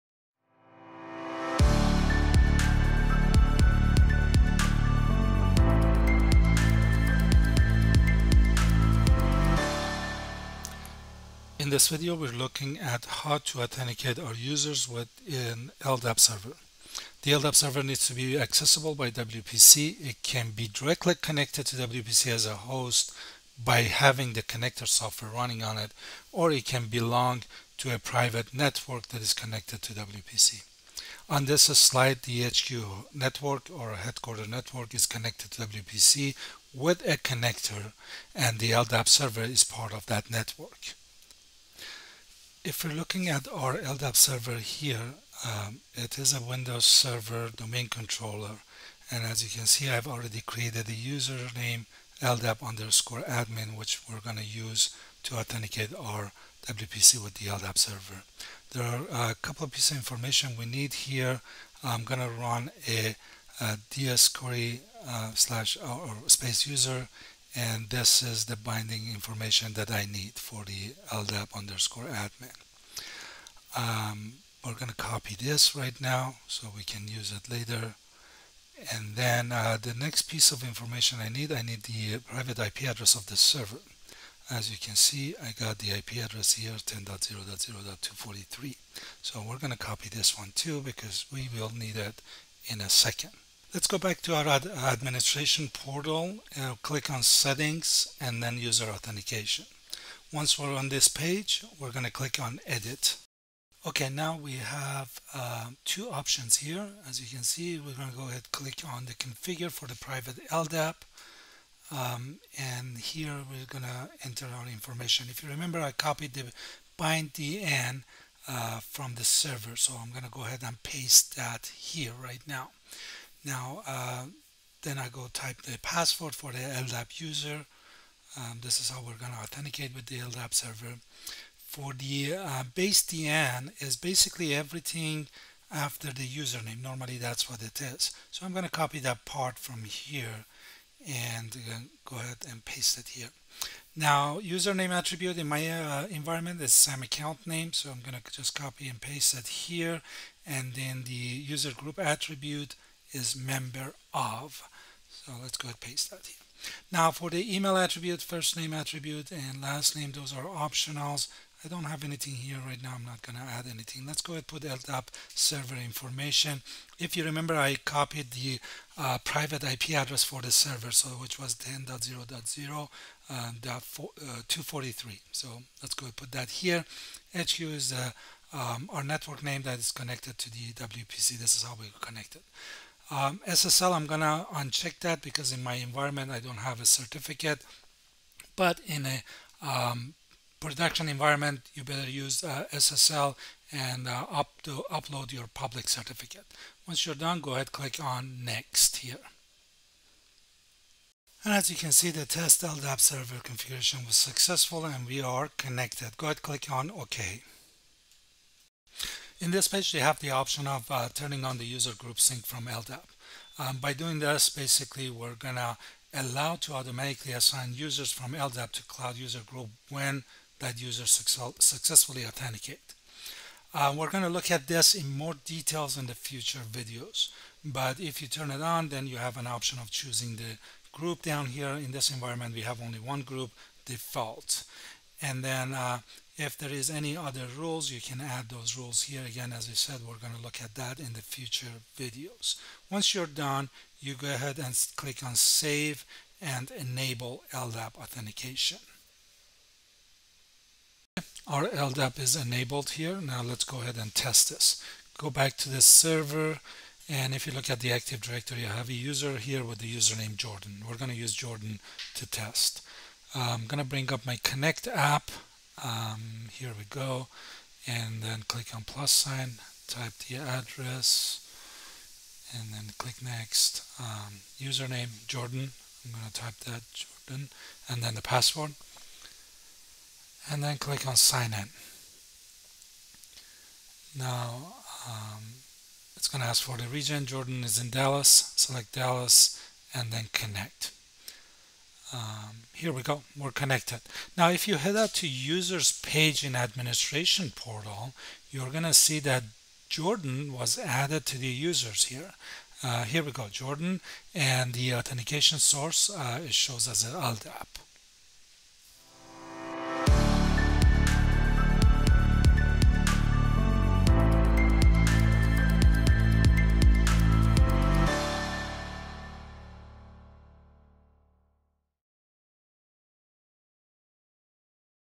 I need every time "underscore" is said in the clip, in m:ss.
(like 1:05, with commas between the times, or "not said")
0:52, 1:11.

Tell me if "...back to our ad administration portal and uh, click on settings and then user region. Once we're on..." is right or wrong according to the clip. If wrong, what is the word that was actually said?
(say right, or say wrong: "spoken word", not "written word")
wrong: "authentication", not "region".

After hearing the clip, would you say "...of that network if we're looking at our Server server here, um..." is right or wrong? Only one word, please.
wrong.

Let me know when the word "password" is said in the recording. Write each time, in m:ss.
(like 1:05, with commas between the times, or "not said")
2:05, 4:38.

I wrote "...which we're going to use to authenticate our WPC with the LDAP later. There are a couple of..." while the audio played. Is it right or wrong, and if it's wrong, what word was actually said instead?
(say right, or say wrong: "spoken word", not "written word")
wrong: "server", not "later".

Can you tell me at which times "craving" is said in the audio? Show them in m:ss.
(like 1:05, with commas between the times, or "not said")
not said.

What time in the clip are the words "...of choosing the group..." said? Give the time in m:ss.
3:49.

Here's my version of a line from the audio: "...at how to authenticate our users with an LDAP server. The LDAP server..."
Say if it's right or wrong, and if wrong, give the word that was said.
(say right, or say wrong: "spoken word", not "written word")
right.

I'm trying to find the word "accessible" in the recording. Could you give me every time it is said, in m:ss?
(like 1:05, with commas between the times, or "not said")
0:18.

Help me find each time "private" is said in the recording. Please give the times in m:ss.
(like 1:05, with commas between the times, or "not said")
0:27, 1:22, 1:49, 2:49.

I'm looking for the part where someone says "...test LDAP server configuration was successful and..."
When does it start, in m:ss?
3:22.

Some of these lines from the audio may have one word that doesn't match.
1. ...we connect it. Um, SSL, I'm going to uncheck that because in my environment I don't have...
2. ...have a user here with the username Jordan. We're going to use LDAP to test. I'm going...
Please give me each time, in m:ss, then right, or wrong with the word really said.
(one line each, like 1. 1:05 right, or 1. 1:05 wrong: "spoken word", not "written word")
1. 3:01 right
2. 4:18 wrong: "Jordan", not "LDAP".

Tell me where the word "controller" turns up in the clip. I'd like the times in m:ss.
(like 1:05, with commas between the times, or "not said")
0:47.